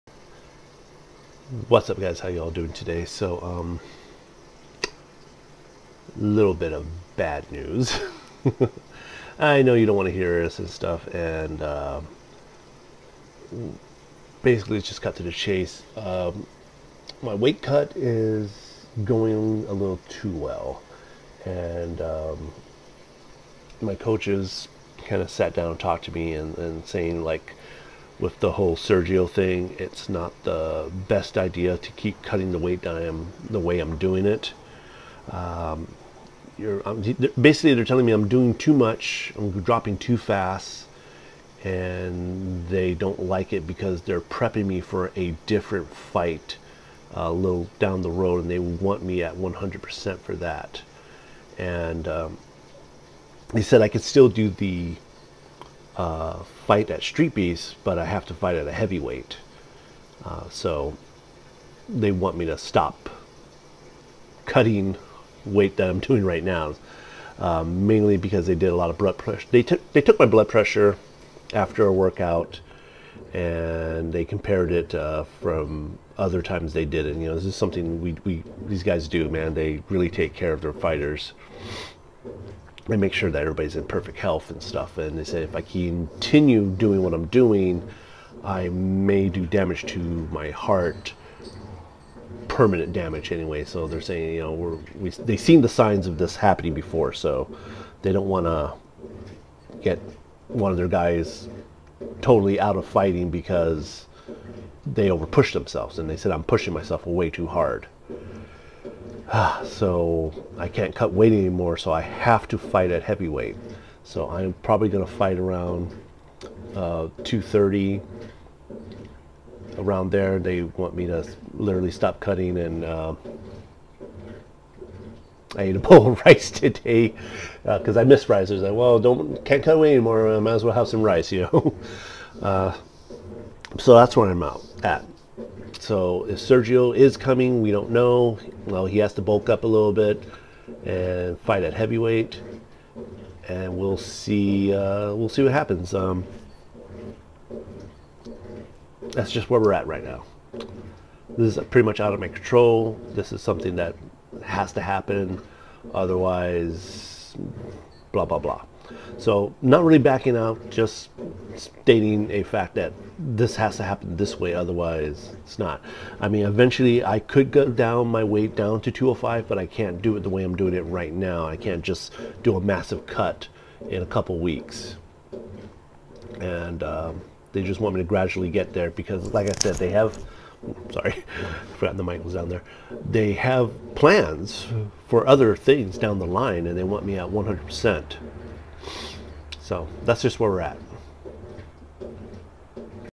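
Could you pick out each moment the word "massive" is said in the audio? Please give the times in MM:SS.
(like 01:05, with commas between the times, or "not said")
02:52.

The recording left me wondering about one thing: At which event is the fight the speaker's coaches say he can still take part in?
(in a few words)
Street Beast.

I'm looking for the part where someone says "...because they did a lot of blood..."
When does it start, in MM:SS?
01:08.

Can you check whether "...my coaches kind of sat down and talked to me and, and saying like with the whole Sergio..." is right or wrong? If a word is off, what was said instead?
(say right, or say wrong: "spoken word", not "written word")
right.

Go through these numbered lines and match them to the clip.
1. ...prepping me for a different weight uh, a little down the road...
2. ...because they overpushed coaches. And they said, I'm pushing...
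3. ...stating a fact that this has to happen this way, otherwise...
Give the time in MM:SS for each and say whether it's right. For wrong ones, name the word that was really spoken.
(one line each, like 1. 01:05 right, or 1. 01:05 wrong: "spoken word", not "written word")
1. 00:44 wrong: "fight", not "weight"
2. 01:43 wrong: "themselves", not "coaches"
3. 02:41 right.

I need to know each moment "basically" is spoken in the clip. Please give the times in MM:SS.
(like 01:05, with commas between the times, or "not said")
00:14, 00:37.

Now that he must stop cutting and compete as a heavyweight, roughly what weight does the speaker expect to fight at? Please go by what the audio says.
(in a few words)
230.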